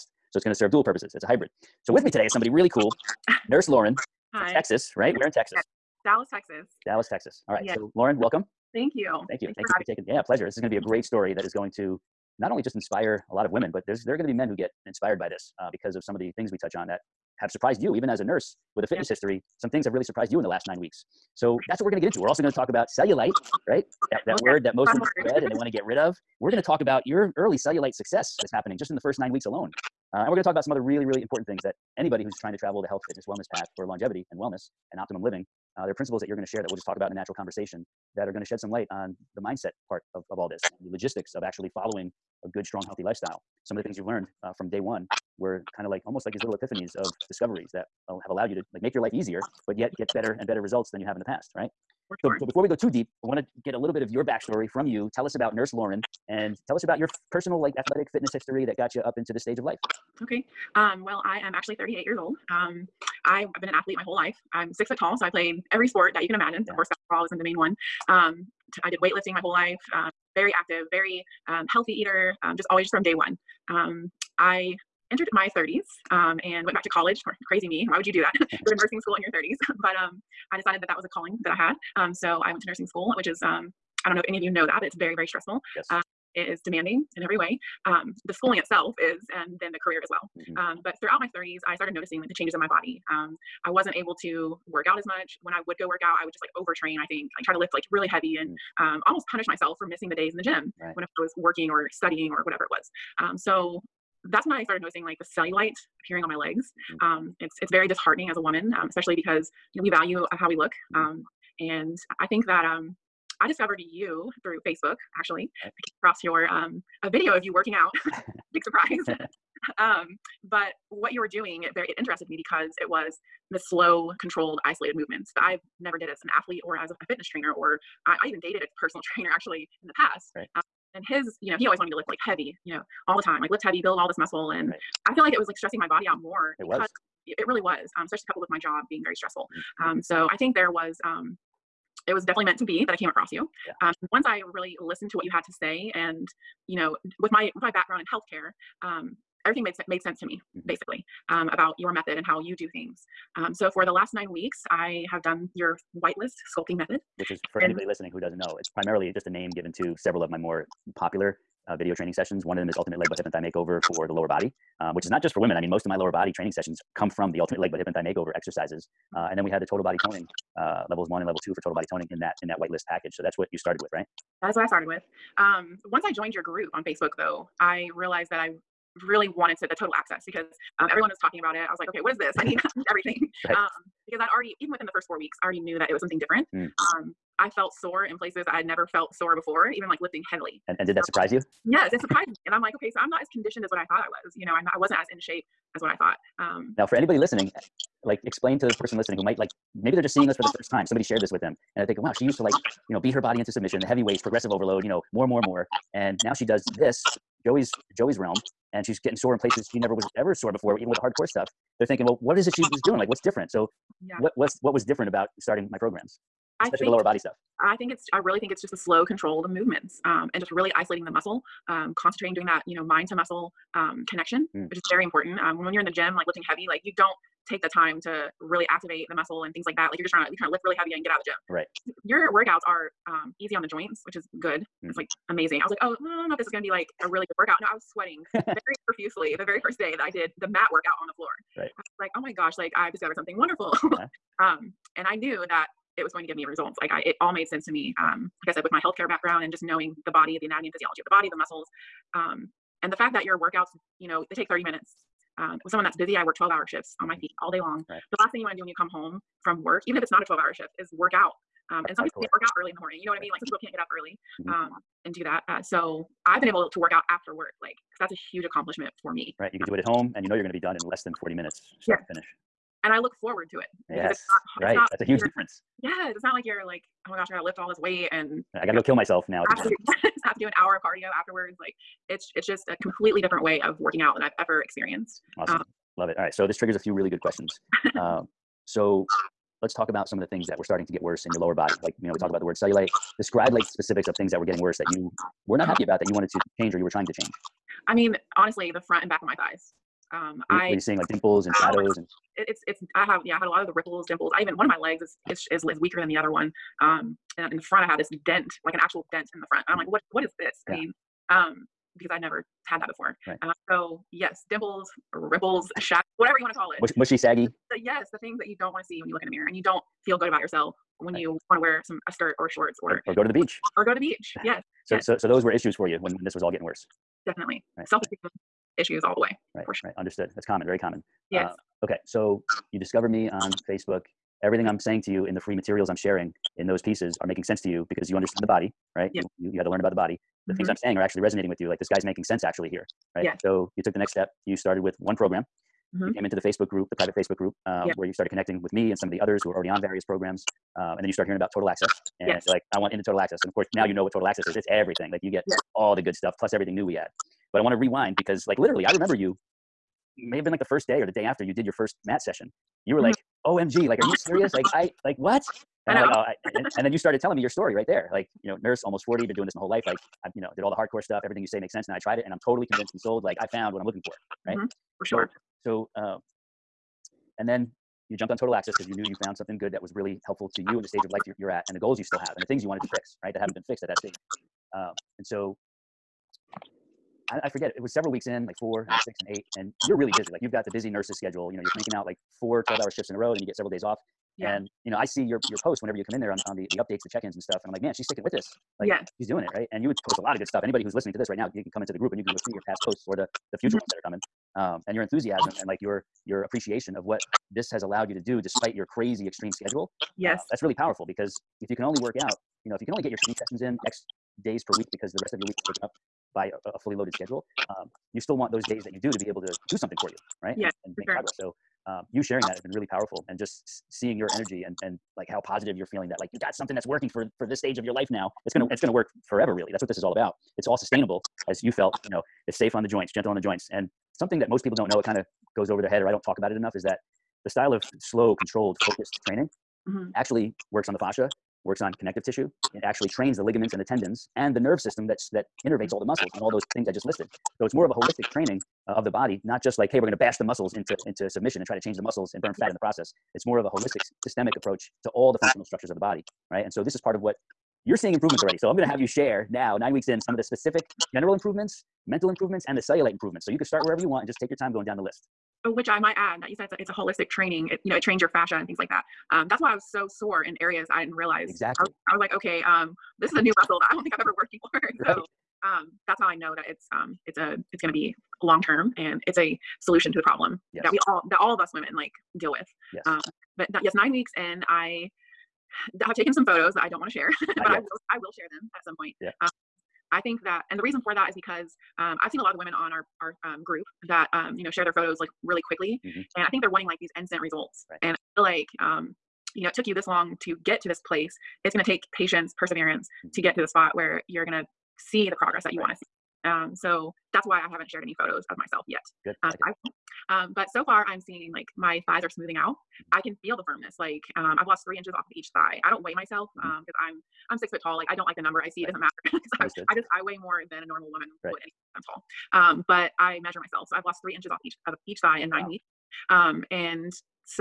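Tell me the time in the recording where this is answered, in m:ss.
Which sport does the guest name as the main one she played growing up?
1:06.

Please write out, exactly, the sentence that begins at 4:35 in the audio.
Yes, it's not like you're like, oh my gosh, I gotta lift all this weight and I gotta go kill myself now.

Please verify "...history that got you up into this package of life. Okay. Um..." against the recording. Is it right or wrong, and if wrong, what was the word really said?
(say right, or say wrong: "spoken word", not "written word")
wrong: "stage", not "package".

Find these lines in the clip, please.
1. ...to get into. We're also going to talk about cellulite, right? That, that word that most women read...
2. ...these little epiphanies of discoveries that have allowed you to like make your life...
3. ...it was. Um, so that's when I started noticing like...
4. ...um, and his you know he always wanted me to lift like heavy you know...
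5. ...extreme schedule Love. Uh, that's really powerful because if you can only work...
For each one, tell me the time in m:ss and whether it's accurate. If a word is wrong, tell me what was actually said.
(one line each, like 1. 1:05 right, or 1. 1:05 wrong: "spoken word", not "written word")
1. 0:21 right
2. 0:46 right
3. 1:42 right
4. 2:10 right
5. 6:49 wrong: "Yes", not "Love".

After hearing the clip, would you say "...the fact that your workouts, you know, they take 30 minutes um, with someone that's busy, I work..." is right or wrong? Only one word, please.
right.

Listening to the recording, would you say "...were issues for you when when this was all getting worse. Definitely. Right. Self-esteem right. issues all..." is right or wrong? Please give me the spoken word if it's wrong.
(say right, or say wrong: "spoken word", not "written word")
right.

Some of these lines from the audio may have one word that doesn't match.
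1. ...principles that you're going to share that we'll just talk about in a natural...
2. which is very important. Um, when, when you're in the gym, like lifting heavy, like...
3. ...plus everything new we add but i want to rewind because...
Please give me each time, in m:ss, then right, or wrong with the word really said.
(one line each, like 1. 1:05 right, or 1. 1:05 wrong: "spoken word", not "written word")
1. 0:35 right
2. 3:44 right
3. 5:56 right.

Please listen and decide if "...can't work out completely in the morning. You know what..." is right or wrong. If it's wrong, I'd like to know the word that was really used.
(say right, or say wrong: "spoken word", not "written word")
wrong: "early", not "completely".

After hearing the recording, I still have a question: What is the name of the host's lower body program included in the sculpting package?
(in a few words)
Ultimate Leg Butt Hip and Thigh Makeover.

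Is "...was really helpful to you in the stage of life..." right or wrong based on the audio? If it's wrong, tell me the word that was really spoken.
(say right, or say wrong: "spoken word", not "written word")
right.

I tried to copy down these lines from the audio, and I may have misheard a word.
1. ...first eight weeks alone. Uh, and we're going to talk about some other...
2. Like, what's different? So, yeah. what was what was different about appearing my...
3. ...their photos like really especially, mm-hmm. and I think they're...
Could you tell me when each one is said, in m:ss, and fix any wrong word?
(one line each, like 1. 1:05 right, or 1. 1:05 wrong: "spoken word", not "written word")
1. 0:28 wrong: "nine", not "eight"
2. 3:32 wrong: "starting", not "appearing"
3. 8:14 wrong: "quickly", not "especially".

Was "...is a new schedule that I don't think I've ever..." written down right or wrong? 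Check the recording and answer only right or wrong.
wrong.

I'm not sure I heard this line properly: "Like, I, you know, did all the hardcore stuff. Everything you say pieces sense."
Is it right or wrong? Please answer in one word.
wrong.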